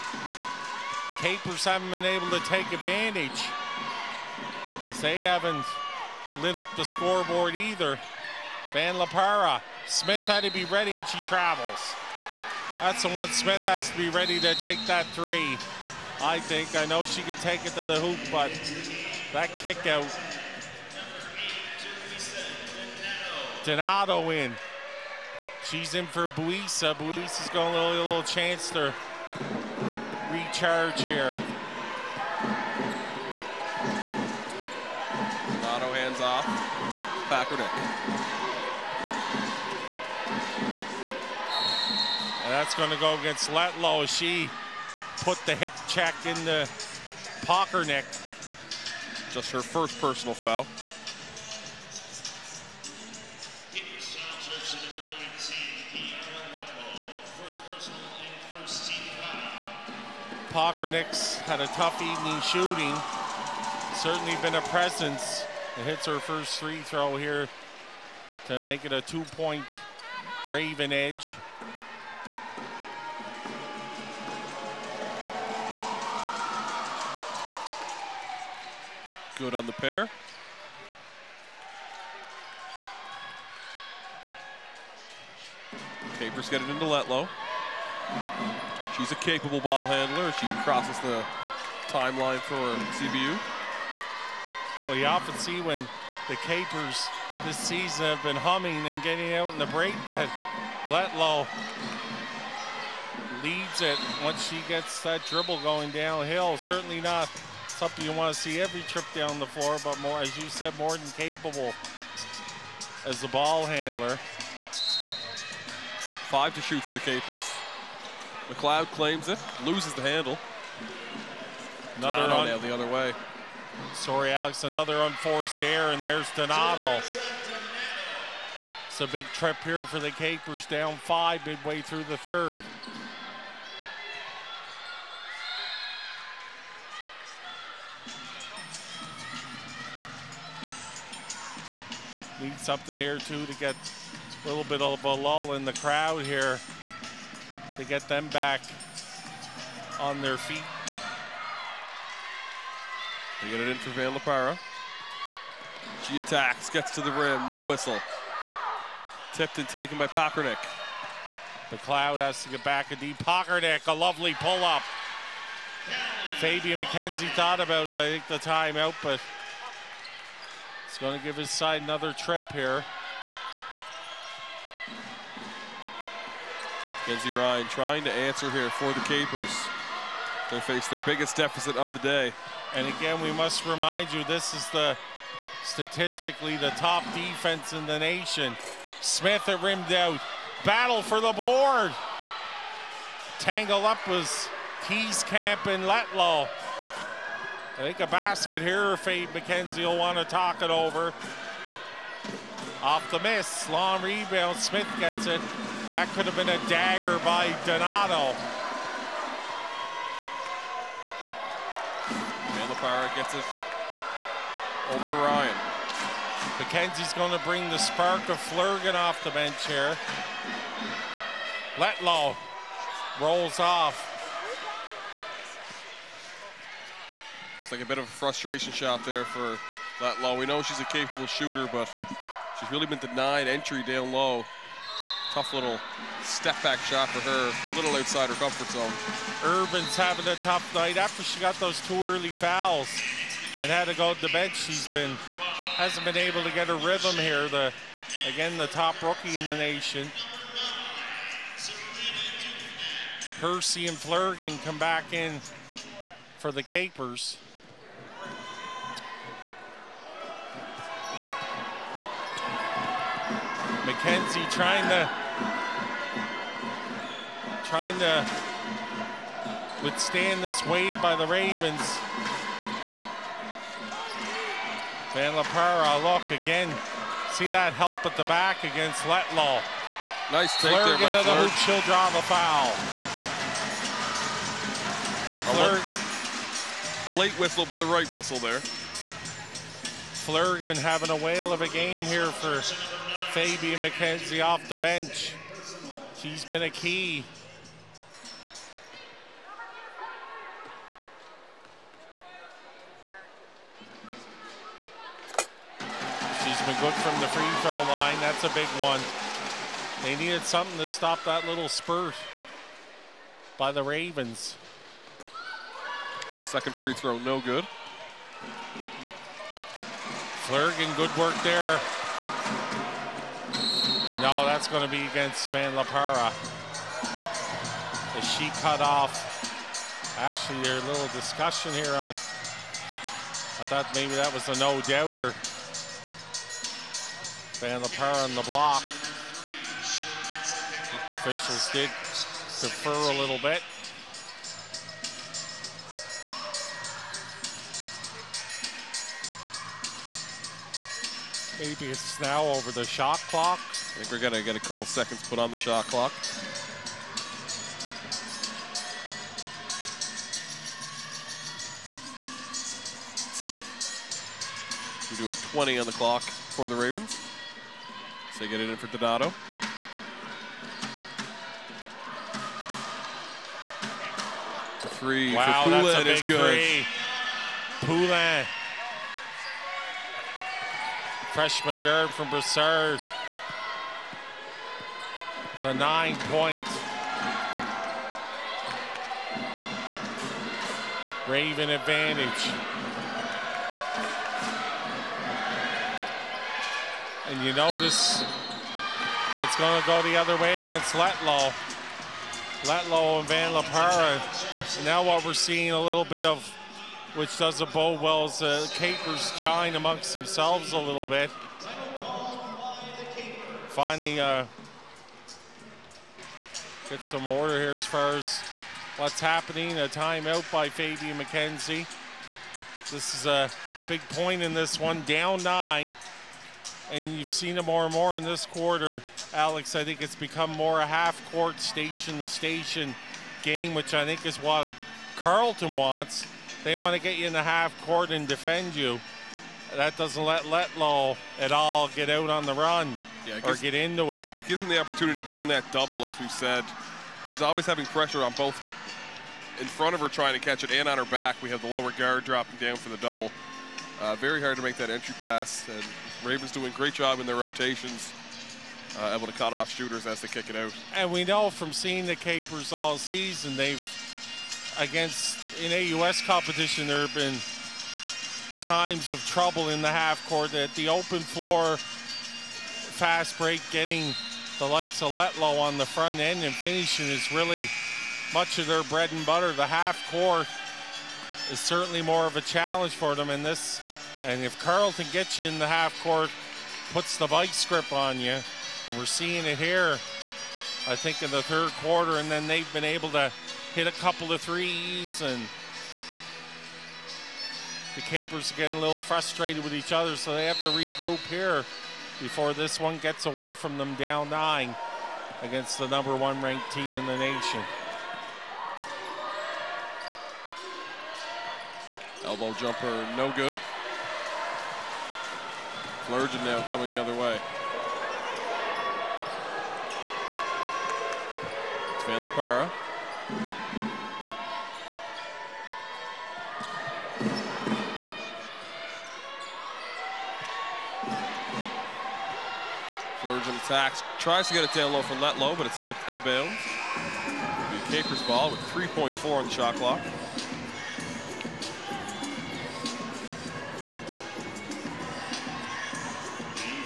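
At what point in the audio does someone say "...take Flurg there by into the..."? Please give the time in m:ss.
4:40.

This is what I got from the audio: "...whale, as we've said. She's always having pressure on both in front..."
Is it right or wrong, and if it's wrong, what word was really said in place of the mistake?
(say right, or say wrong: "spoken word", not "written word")
wrong: "double", not "whale".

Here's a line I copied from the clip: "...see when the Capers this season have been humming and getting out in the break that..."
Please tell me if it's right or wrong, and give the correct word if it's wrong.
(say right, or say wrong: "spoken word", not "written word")
right.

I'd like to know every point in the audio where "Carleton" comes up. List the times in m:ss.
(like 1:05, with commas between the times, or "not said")
7:15, 8:04.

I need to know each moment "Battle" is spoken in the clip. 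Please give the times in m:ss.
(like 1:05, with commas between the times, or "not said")
3:10.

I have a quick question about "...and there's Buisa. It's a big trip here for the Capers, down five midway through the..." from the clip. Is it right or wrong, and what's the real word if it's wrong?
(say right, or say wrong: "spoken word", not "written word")
wrong: "Donato", not "Buisa".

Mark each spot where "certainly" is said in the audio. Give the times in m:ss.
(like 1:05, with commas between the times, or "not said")
1:03, 1:46, 8:01.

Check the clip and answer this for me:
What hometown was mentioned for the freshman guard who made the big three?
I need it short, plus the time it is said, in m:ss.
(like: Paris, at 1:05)
Brossard, at 6:22.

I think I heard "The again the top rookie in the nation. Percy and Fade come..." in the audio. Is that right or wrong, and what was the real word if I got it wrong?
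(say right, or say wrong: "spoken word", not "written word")
wrong: "Flurgeon", not "Fade".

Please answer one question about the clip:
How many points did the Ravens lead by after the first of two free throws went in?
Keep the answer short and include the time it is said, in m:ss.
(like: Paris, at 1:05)
2, at 1:09.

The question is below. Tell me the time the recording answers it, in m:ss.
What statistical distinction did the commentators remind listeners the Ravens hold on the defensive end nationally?
3:06.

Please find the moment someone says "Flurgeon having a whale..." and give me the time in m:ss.
4:50.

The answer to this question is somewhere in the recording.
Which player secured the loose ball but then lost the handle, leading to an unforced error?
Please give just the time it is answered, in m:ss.
1:58.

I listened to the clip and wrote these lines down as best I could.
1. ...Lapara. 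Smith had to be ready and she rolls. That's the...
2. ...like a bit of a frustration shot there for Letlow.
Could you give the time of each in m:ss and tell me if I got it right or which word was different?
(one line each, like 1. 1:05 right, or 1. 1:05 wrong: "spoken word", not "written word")
1. 0:08 wrong: "travels", not "rolls"
2. 3:47 right.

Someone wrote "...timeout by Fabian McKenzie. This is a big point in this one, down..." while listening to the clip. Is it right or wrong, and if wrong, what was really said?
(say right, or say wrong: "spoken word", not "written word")
right.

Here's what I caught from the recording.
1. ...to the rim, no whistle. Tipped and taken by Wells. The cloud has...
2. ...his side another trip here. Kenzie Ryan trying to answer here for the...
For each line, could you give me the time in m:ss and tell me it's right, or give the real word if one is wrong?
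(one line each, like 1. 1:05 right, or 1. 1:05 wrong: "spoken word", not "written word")
1. 2:36 wrong: "Pocrnic", not "Wells"
2. 2:51 right.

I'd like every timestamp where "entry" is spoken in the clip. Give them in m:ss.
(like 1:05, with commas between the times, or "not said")
3:53, 7:34.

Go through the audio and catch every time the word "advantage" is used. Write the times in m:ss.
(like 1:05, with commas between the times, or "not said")
0:02, 6:31.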